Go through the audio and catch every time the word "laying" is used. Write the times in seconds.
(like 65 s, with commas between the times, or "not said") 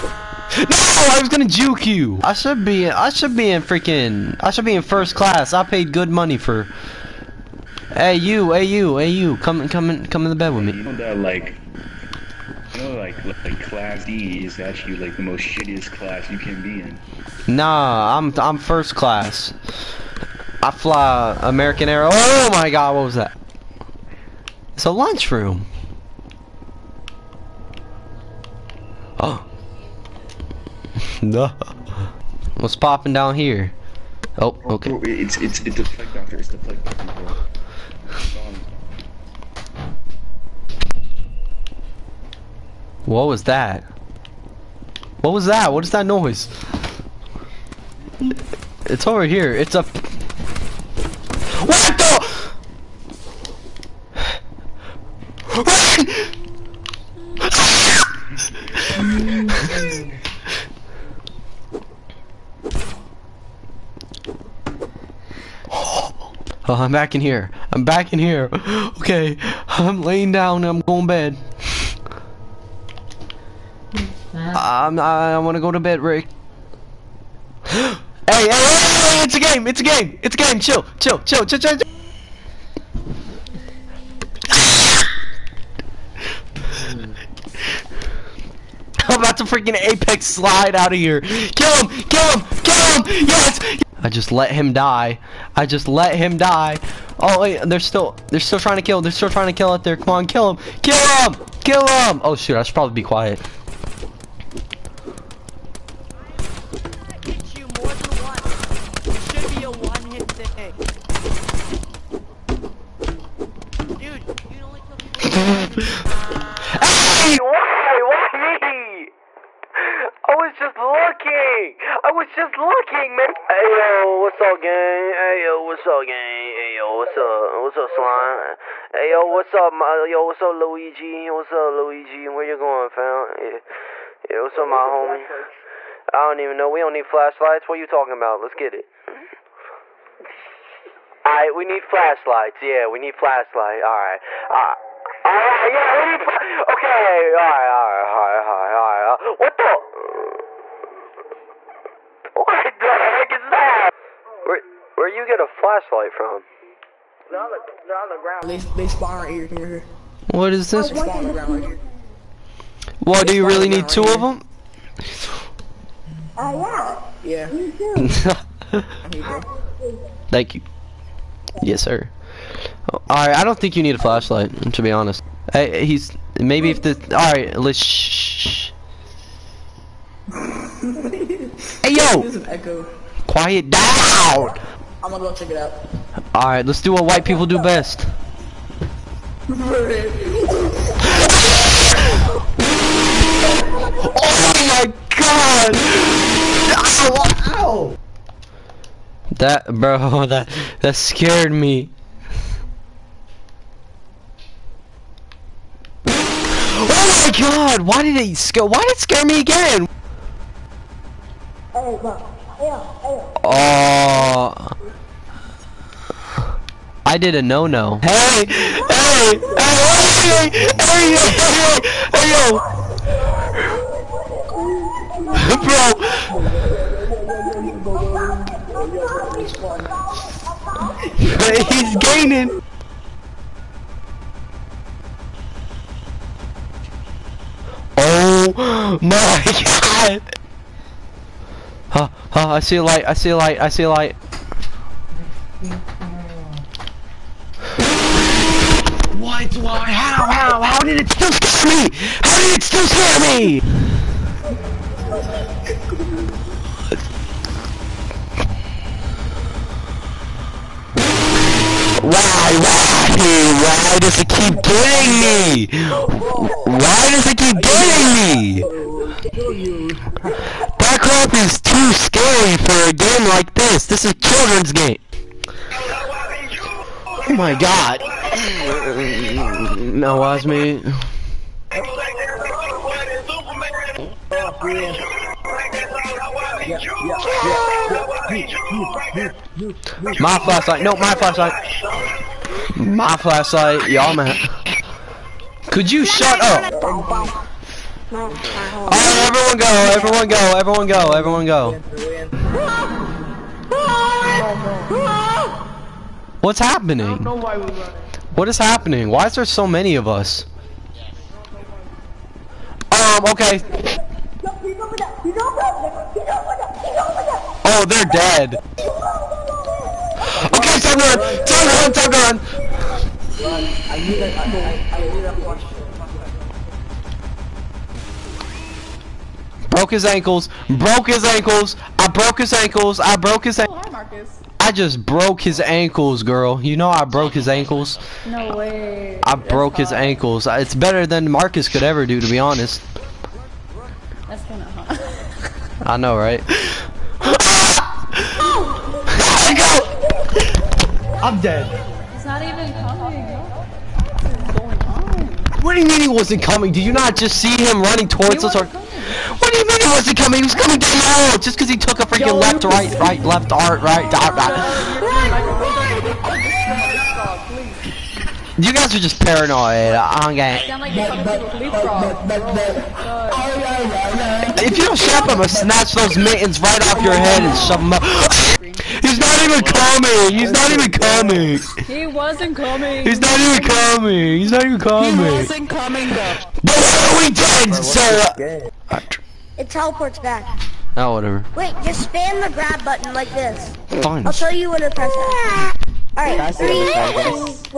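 70 s.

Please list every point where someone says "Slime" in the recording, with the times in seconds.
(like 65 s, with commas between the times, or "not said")
127 s.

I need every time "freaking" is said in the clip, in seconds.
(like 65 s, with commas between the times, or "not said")
3 s, 89 s, 362 s.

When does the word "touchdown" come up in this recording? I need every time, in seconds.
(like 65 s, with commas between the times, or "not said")
not said.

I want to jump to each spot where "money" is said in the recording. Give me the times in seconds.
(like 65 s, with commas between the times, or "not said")
6 s.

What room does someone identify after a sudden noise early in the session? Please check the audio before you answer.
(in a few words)
Lunchroom.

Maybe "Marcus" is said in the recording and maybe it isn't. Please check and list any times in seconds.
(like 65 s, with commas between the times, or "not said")
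333 s, 341 s.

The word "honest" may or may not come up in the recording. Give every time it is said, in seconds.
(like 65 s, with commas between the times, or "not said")
174 s, 342 s.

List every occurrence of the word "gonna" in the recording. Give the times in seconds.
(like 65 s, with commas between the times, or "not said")
1 s, 185 s, 375 s.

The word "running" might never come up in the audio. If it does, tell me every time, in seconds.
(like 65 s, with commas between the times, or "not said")
357 s.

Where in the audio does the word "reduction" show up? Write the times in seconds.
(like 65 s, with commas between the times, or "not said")
not said.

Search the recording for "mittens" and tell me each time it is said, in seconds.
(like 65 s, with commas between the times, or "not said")
376 s.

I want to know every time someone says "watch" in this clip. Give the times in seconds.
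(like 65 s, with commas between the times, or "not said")
280 s.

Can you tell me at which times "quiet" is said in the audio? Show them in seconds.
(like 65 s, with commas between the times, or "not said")
103 s, 183 s.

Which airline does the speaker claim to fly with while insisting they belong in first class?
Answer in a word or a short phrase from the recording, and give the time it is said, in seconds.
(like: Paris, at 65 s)
American Air, at 21 s.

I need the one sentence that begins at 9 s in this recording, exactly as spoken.
Come, come, come in the bed with me.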